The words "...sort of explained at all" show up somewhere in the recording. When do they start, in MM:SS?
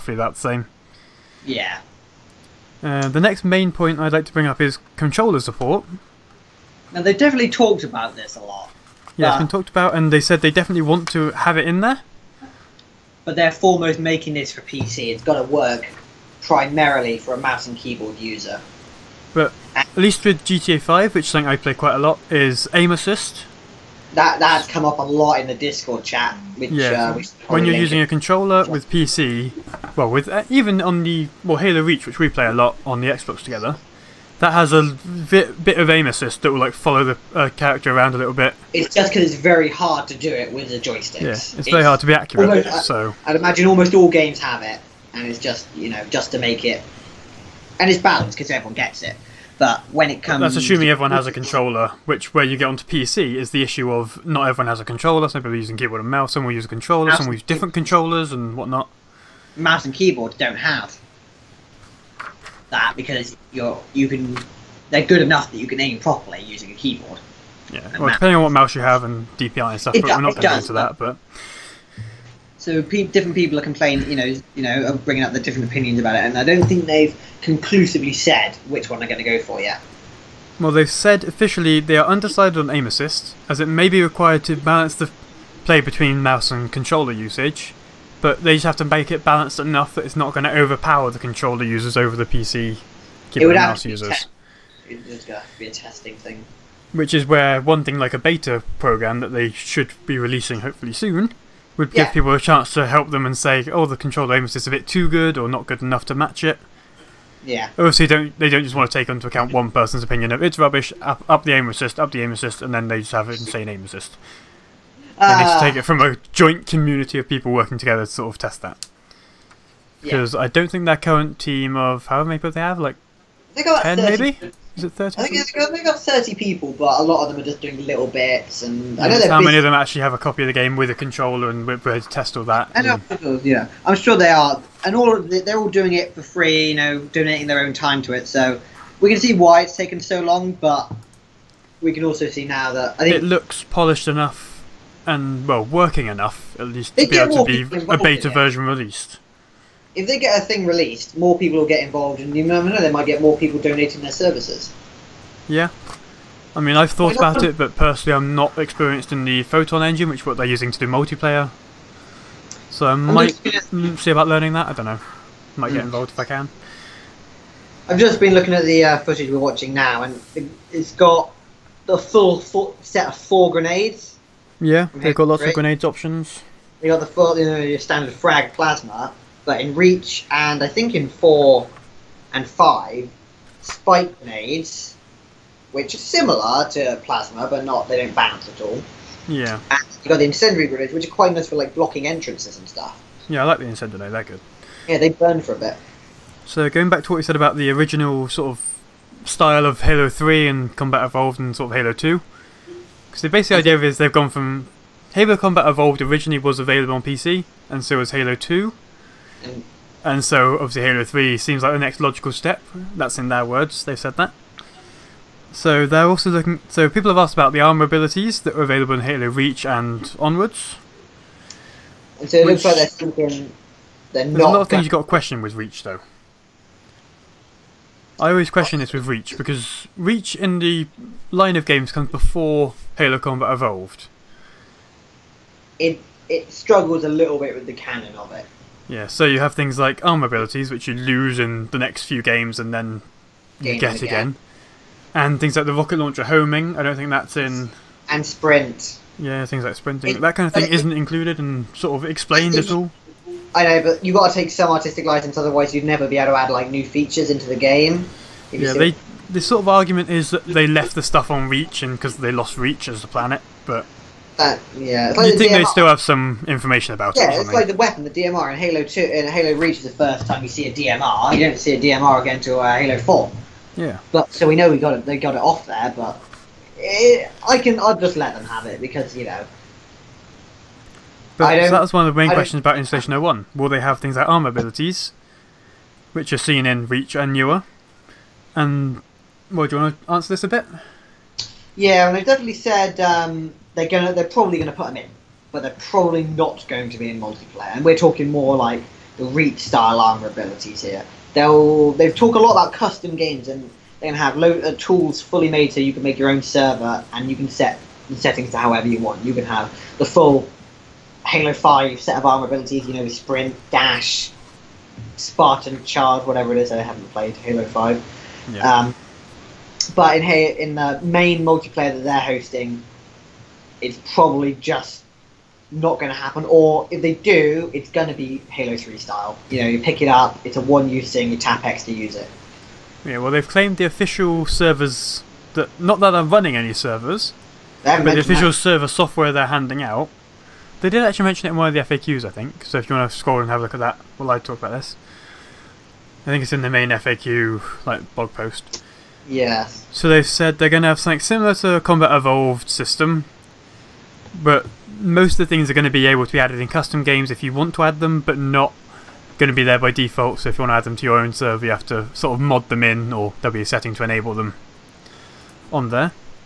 04:11.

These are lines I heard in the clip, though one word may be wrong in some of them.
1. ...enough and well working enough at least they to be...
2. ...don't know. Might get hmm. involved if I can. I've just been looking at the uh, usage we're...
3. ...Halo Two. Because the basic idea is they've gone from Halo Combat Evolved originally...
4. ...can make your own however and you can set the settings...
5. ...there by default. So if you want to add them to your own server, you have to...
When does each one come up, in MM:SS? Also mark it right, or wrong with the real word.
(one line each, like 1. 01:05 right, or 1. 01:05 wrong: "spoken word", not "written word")
1. 02:24 right
2. 02:44 wrong: "footage", not "usage"
3. 03:21 right
4. 05:05 wrong: "server", not "however"
5. 05:59 right.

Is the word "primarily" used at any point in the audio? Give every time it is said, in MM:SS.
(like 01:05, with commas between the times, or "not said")
00:16.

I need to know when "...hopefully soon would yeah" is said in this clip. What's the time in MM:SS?
01:40.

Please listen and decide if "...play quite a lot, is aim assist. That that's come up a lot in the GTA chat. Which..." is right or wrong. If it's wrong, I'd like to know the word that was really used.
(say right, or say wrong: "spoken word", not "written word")
wrong: "Discord", not "GTA".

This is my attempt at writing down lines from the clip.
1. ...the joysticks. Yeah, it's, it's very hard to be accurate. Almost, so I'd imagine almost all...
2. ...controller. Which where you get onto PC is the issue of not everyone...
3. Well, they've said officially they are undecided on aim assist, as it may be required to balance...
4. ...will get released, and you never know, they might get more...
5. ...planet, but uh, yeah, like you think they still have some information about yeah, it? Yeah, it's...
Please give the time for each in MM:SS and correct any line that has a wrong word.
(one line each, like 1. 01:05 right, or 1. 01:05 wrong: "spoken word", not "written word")
1. 00:40 right
2. 00:51 right
3. 01:20 right
4. 02:31 wrong: "involved", not "released"
5. 04:23 right.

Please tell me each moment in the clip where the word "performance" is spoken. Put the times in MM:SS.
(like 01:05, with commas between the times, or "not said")
not said.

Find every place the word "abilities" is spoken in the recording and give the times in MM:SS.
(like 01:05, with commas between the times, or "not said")
03:37, 04:00, 04:44, 05:00, 05:12.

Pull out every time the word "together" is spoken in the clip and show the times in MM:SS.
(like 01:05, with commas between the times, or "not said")
00:33, 01:57.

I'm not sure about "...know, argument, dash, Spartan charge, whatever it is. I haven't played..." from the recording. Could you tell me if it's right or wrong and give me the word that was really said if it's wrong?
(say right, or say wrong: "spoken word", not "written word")
wrong: "sprint", not "argument".